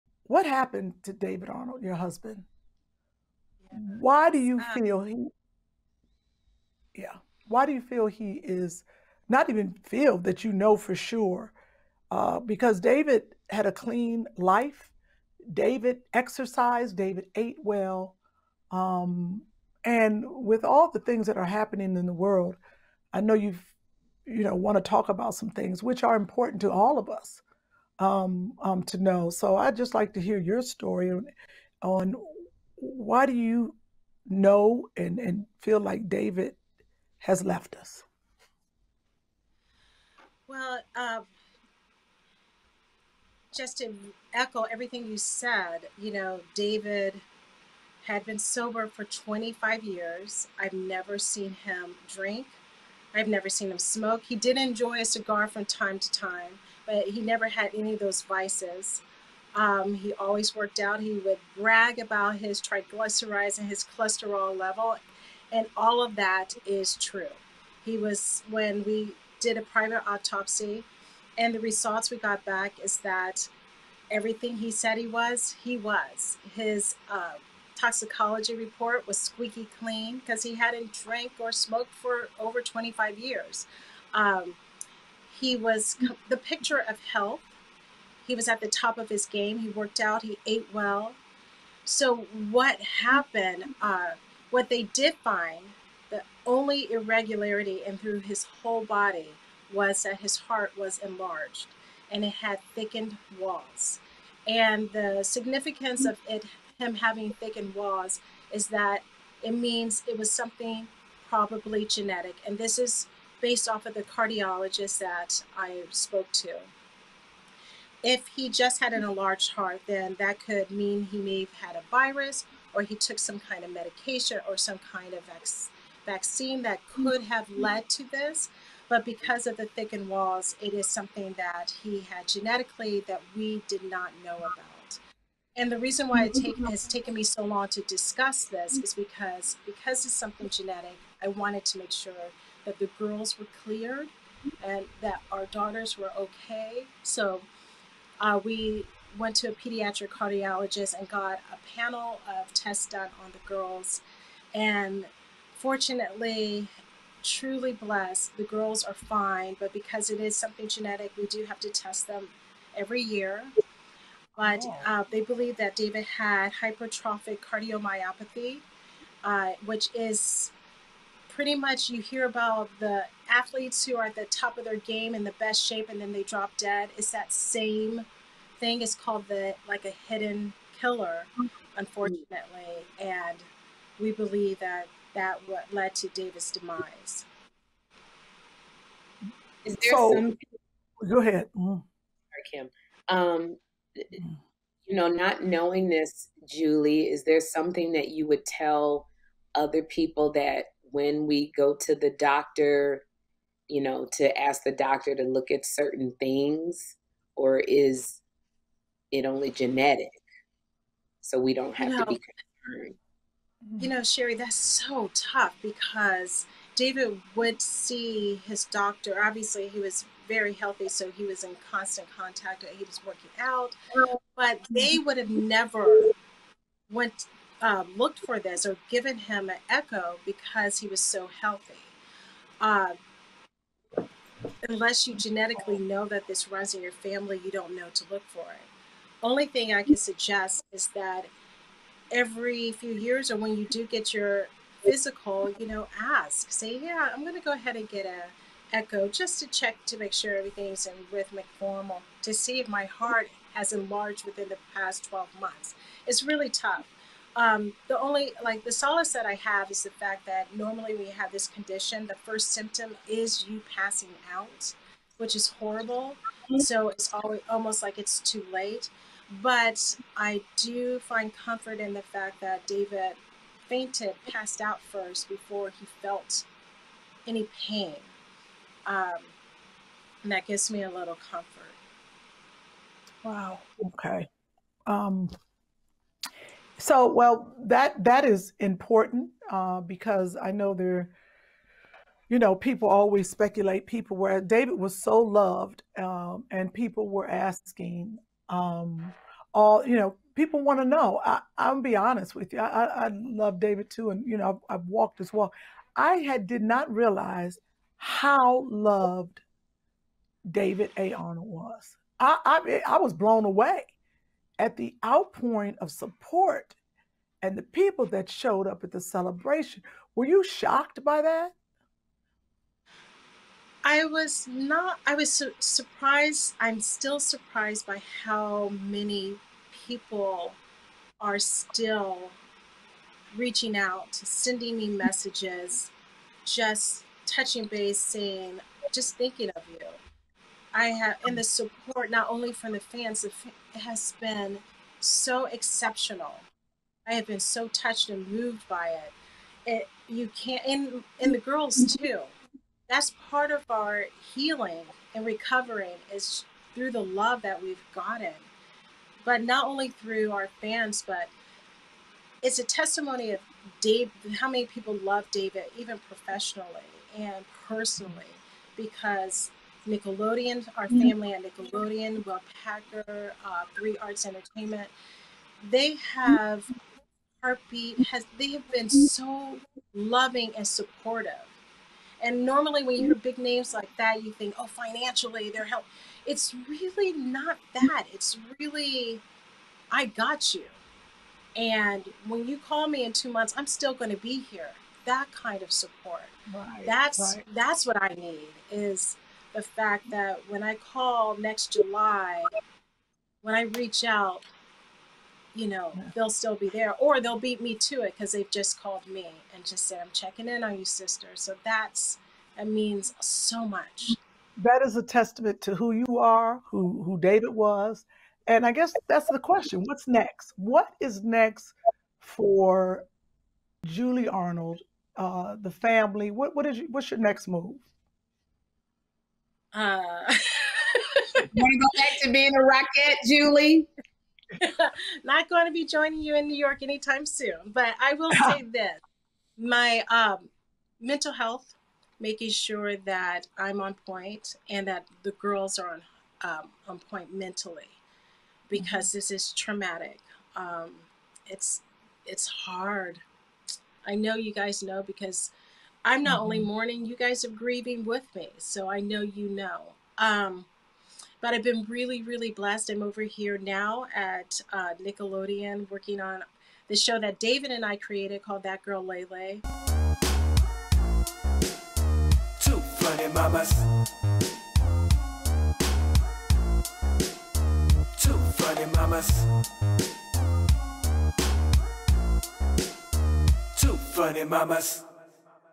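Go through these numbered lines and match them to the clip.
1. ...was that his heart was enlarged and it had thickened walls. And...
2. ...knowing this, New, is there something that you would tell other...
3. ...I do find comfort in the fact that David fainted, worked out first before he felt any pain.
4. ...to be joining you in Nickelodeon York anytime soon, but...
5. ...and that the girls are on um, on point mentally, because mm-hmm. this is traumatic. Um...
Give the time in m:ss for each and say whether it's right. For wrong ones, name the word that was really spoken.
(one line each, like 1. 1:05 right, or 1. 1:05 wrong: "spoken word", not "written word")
1. 1:39 right
2. 3:15 wrong: "Julie", not "New"
3. 4:30 wrong: "passed", not "worked"
4. 7:15 wrong: "New", not "Nickelodeon"
5. 7:24 right.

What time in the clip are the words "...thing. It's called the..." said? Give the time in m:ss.
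2:58.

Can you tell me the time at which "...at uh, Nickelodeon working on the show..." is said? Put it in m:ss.
7:44.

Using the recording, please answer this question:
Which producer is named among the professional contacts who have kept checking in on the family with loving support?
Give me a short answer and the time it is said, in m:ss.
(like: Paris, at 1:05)
Will Packer, at 6:12.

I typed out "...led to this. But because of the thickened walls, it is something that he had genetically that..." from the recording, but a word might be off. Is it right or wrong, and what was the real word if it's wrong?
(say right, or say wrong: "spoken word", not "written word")
right.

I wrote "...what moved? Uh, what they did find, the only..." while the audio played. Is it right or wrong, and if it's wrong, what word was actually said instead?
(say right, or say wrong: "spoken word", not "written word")
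wrong: "happened", not "moved".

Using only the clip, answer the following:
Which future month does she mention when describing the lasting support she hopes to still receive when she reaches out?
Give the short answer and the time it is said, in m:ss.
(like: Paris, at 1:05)
July, at 6:41.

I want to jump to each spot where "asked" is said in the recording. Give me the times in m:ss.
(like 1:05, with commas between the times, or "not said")
not said.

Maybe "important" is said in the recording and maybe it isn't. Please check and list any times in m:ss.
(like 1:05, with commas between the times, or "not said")
0:26, 4:48.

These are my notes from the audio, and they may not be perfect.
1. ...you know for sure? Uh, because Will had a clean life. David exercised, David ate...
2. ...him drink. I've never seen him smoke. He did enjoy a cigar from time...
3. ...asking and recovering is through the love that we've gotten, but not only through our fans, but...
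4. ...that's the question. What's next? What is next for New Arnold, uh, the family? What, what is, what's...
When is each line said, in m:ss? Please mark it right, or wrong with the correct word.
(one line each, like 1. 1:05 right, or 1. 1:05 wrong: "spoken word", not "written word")
1. 0:10 wrong: "David", not "Will"
2. 0:51 right
3. 5:54 wrong: "healing", not "asking"
4. 6:59 wrong: "Julie", not "New".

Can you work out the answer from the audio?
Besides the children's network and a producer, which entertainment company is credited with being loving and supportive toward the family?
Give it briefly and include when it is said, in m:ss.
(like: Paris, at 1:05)
Three Arts Entertainment, at 6:13.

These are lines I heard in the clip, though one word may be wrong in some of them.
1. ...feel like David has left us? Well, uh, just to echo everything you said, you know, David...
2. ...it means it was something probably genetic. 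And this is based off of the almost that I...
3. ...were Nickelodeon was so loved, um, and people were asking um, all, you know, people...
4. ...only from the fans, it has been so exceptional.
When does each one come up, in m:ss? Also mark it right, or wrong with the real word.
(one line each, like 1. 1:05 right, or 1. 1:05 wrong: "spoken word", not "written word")
1. 0:35 right
2. 1:49 wrong: "cardiologist", not "almost"
3. 4:54 wrong: "David", not "Nickelodeon"
4. 5:42 right.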